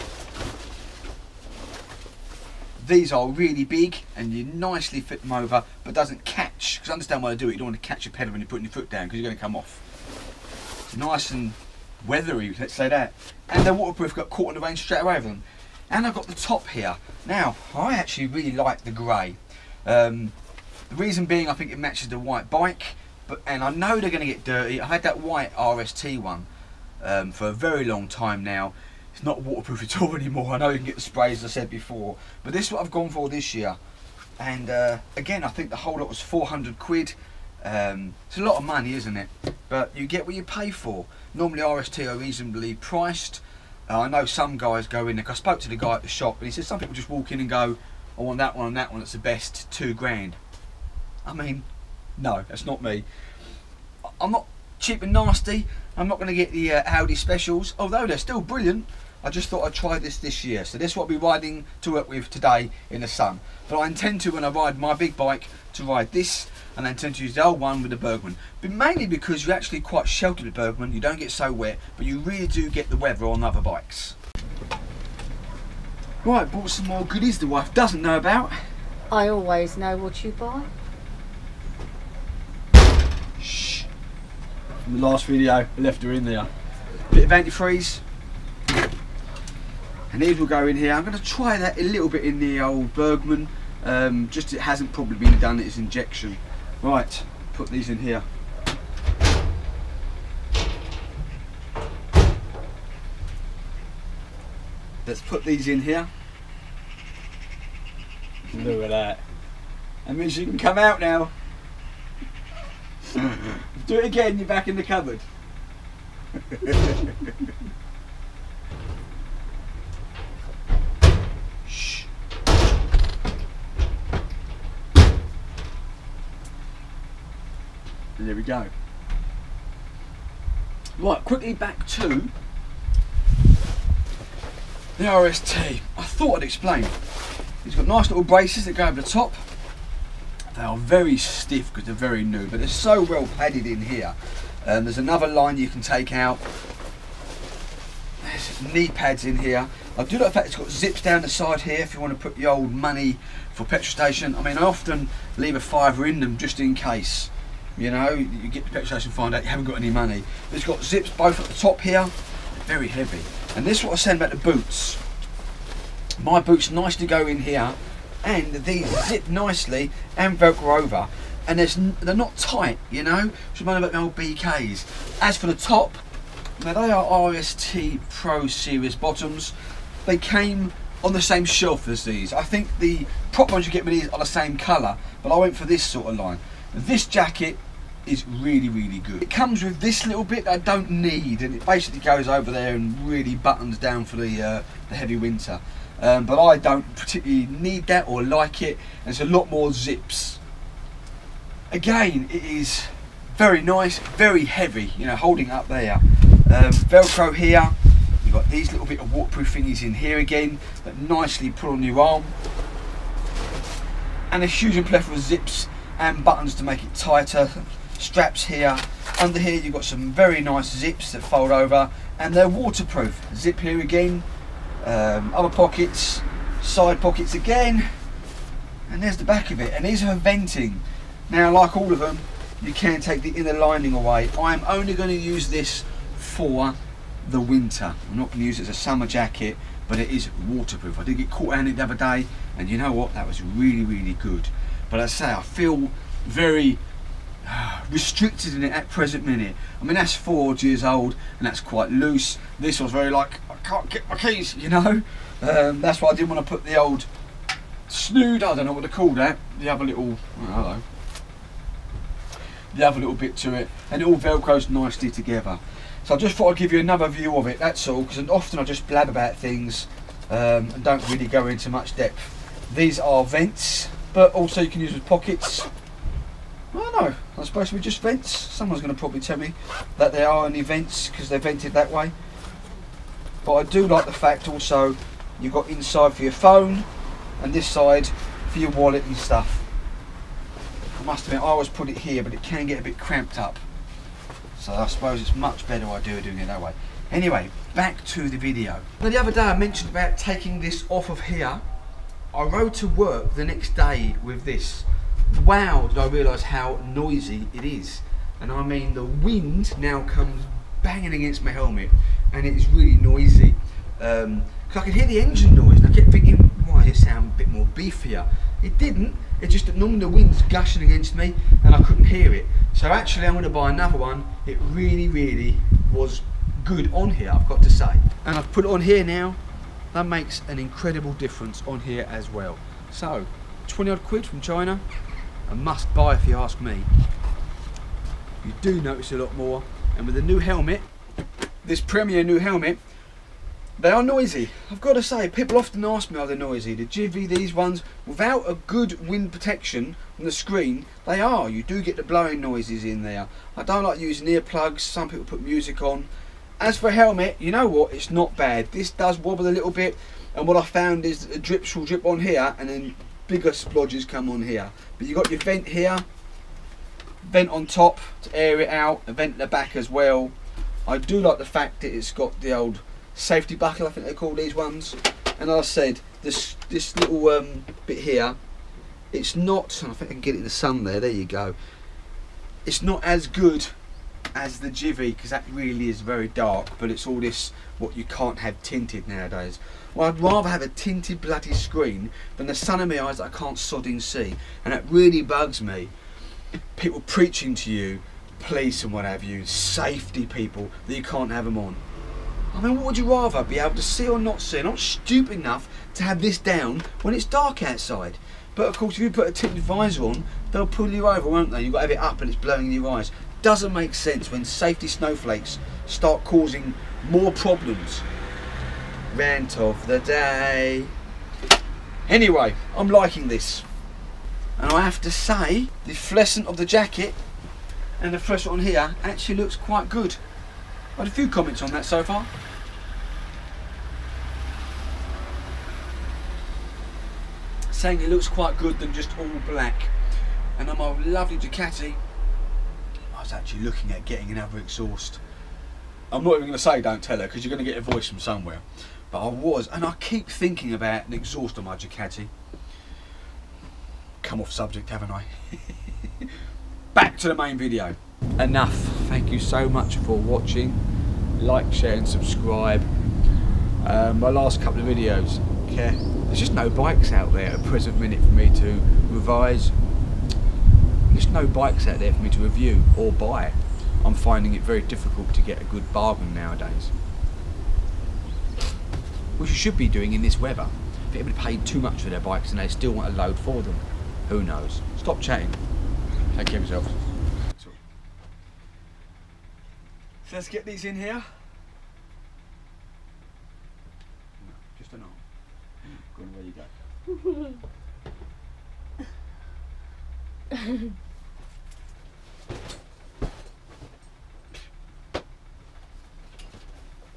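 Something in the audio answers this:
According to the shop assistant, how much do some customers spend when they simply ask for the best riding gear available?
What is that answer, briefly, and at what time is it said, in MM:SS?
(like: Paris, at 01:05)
two grand, at 00:49.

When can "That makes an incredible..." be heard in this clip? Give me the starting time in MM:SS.
05:29.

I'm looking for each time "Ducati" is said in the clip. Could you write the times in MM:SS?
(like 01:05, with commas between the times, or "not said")
07:21, 07:31.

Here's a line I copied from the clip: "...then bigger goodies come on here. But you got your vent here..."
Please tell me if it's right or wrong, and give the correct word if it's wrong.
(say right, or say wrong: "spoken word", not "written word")
wrong: "splodges", not "goodies".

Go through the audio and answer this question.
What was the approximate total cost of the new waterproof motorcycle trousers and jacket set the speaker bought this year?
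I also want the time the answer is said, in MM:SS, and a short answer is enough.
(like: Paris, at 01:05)
400 quid, at 00:36.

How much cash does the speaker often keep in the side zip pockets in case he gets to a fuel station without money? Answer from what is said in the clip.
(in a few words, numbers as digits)
a fiver.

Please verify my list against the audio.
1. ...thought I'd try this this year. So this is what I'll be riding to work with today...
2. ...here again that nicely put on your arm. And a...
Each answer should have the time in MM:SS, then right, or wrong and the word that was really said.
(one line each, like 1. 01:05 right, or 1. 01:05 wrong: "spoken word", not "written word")
1. 00:59 right
2. 03:29 right.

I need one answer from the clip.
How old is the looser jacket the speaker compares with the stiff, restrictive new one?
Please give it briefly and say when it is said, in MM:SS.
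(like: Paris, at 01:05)
four years, at 04:10.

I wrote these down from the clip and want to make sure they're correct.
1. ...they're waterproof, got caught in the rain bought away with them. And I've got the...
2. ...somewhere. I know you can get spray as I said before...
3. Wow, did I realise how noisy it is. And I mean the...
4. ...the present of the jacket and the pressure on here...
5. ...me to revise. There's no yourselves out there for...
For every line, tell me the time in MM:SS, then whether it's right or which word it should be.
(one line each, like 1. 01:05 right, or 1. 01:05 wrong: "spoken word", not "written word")
1. 00:13 wrong: "straight", not "bought"
2. 00:30 wrong: "anymore", not "somewhere"
3. 05:05 right
4. 07:05 wrong: "fluorescent", not "present"
5. 07:48 wrong: "bikes", not "yourselves".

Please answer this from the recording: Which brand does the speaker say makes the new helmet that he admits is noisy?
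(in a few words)
Premier.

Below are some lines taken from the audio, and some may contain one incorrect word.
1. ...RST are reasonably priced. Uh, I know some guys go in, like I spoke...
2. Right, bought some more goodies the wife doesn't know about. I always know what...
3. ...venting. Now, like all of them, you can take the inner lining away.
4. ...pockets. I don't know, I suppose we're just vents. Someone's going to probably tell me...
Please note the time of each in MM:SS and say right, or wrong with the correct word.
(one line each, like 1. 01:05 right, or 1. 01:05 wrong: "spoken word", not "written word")
1. 00:41 right
2. 01:16 right
3. 03:50 right
4. 04:35 right.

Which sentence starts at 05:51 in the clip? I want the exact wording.
You do get the blowing noises in there.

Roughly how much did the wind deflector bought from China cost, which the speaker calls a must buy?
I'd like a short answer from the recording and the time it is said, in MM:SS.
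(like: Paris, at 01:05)
20 odd quid, at 05:33.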